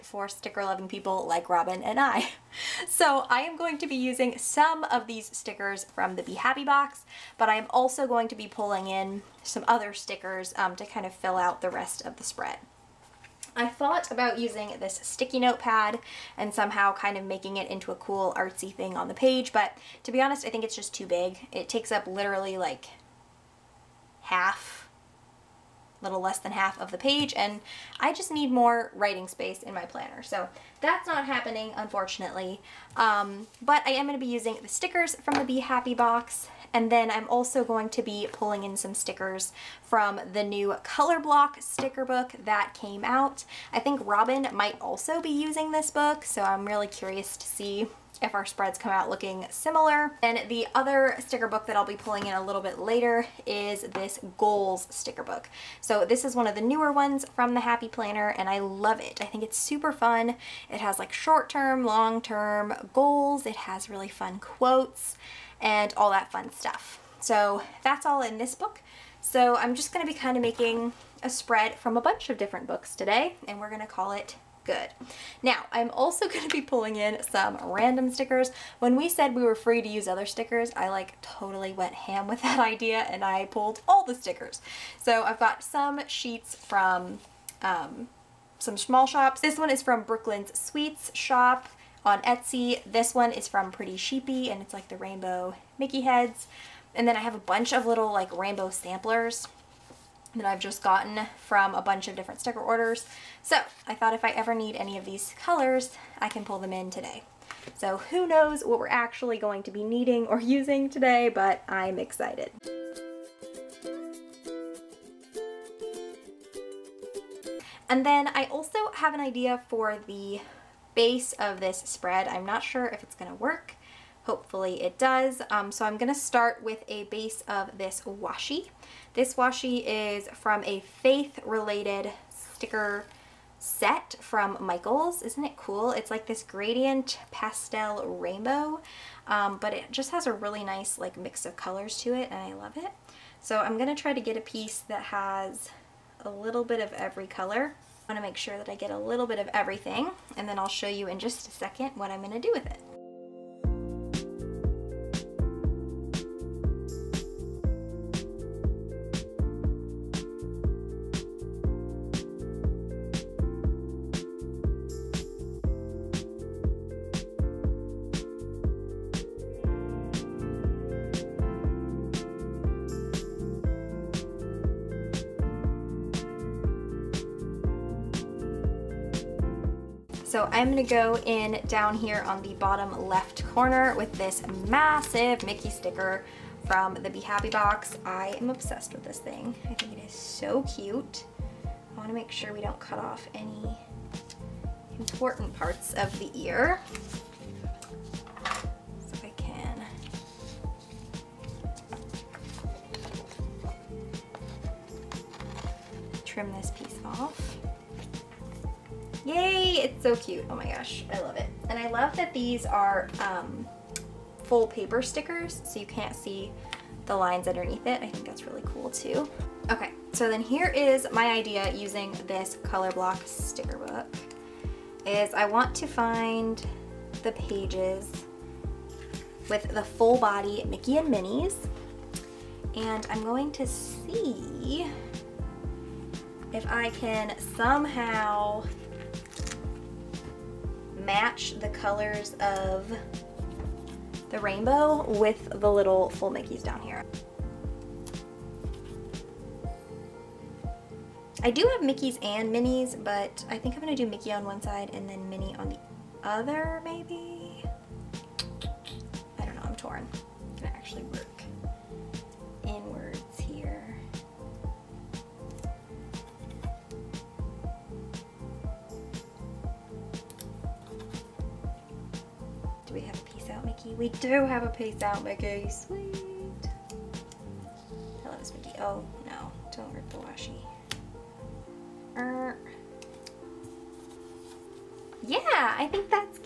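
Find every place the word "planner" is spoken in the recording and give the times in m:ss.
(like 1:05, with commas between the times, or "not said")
0:29, 0:57.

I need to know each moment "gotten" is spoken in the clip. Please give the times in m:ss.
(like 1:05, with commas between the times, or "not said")
1:40.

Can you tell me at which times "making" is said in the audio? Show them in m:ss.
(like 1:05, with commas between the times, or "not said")
0:17, 1:10.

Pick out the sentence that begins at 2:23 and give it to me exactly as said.
So I'm going to try to get a piece that has a little bit of every color.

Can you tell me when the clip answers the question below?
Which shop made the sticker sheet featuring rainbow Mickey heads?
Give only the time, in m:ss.
1:33.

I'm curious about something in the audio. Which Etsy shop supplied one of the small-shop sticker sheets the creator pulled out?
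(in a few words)
Brooklyn's Sweets shop.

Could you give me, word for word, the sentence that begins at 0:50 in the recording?
And the other sticker book that I'll be pulling in a little bit later is this goals sticker book.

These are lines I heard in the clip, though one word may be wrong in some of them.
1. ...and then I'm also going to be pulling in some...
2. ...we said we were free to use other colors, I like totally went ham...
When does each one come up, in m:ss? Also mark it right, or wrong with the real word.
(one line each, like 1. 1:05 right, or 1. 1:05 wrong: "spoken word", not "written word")
1. 0:36 right
2. 1:18 wrong: "stickers", not "colors".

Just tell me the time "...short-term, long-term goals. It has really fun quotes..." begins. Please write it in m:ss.
1:01.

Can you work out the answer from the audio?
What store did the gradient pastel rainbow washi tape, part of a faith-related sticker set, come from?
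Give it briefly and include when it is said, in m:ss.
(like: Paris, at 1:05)
Michaels, at 2:14.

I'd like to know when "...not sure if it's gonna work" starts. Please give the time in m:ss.
2:02.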